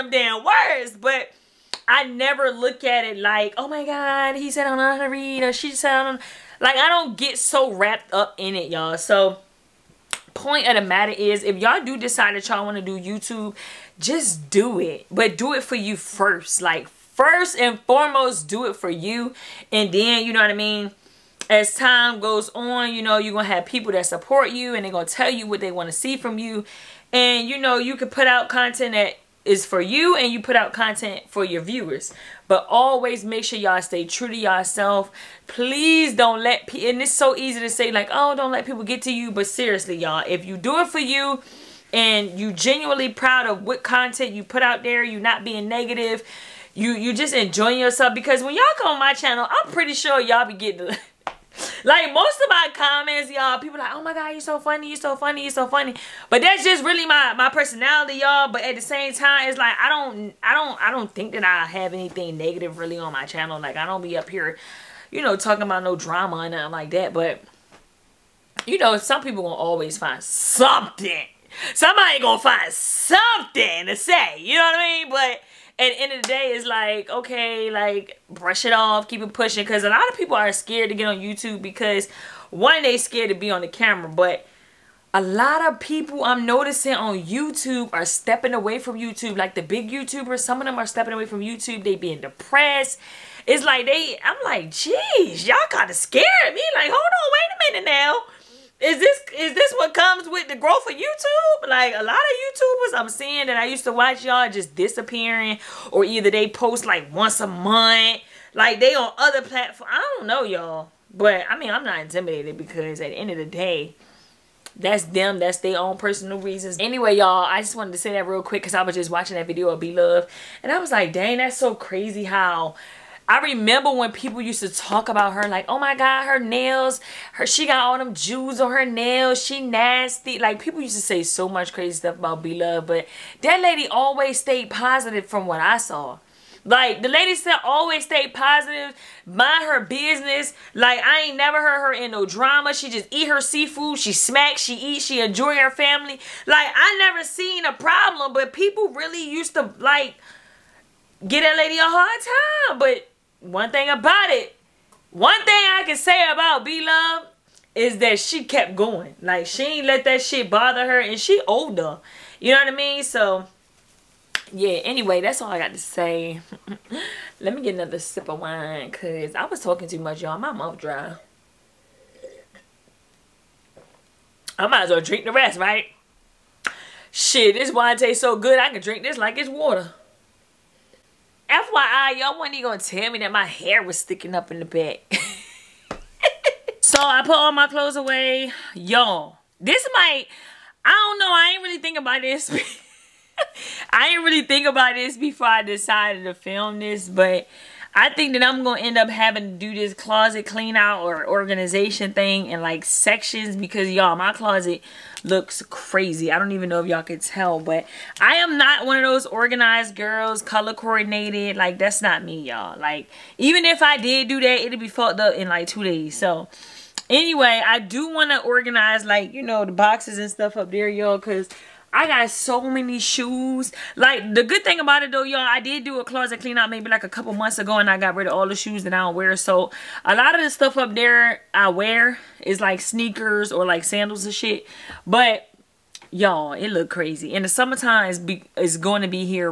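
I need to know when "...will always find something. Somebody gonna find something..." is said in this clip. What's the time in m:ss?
1:09.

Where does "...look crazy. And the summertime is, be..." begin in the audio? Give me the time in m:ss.
3:56.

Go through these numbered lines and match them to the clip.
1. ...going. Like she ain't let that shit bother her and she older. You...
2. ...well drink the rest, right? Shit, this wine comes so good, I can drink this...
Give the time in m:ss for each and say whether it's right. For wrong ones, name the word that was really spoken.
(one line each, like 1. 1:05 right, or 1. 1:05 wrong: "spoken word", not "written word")
1. 2:38 right
2. 2:54 wrong: "tastes", not "comes".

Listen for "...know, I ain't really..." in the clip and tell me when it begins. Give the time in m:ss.
3:11.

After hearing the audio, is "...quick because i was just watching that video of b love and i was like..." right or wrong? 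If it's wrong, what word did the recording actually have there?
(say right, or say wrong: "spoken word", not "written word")
right.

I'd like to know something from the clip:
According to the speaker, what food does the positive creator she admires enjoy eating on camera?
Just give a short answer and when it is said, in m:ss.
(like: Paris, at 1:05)
Seafood, at 2:23.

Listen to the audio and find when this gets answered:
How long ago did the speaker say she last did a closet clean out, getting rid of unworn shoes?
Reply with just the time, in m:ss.
3:47.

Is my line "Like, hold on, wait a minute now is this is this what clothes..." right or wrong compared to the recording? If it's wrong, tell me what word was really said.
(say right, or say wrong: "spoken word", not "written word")
wrong: "comes", not "clothes".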